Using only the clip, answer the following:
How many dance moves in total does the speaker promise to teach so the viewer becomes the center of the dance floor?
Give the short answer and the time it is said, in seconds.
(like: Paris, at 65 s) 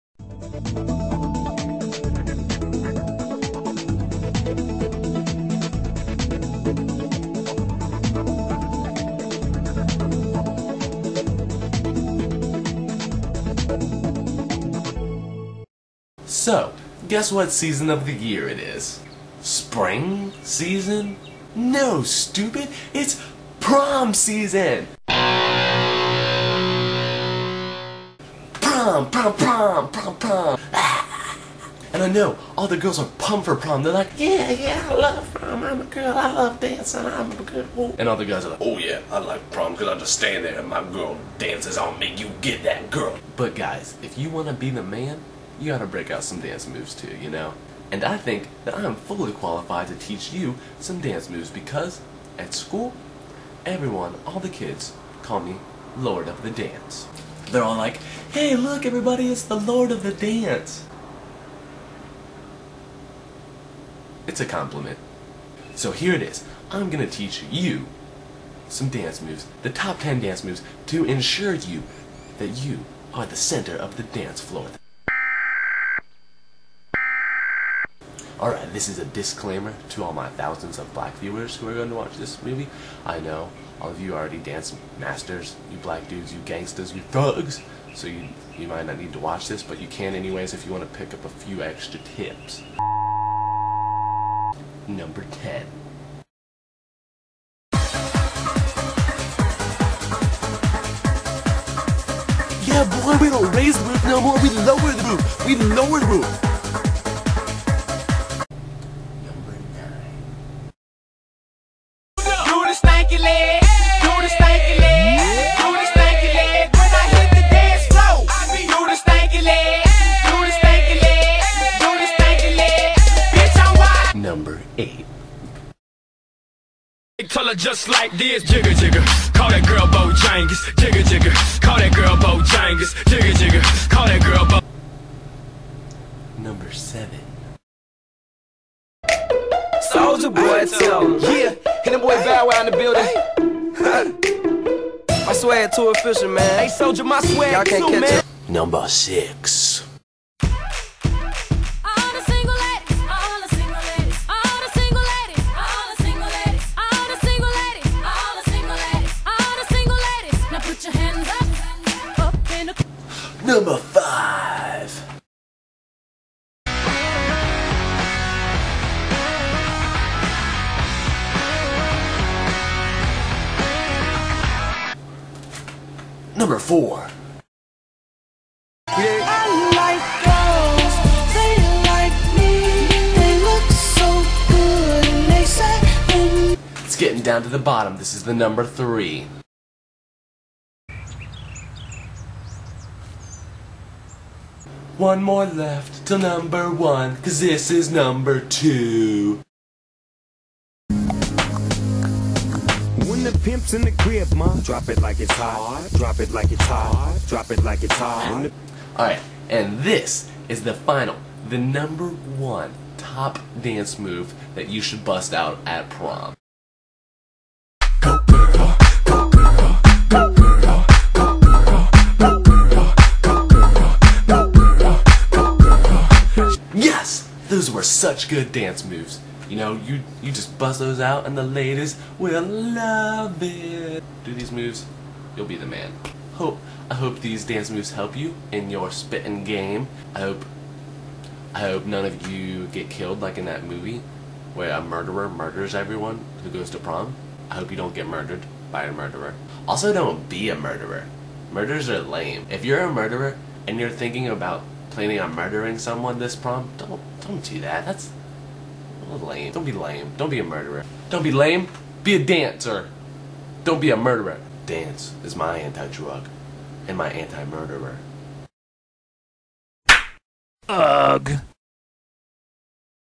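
10, at 69 s.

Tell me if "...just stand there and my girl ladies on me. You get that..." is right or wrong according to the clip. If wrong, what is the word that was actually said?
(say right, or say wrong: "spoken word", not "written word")
wrong: "dances", not "ladies".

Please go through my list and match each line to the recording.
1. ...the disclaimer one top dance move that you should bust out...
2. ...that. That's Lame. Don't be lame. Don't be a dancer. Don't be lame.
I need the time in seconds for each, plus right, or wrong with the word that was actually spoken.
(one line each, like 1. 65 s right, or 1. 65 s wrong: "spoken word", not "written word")
1. 211 s wrong: "number", not "disclaimer"
2. 257 s wrong: "murderer", not "dancer".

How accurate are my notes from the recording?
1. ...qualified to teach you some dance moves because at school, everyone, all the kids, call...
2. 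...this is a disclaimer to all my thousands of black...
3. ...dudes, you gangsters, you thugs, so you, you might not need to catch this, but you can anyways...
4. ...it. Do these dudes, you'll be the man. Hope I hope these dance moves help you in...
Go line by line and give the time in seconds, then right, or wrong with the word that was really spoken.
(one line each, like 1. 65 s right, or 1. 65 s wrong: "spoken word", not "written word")
1. 49 s right
2. 78 s right
3. 86 s wrong: "watch", not "catch"
4. 233 s wrong: "moves", not "dudes".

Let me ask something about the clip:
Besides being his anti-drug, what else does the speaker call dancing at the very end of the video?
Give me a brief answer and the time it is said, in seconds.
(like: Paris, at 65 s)
Anti-murderer, at 267 s.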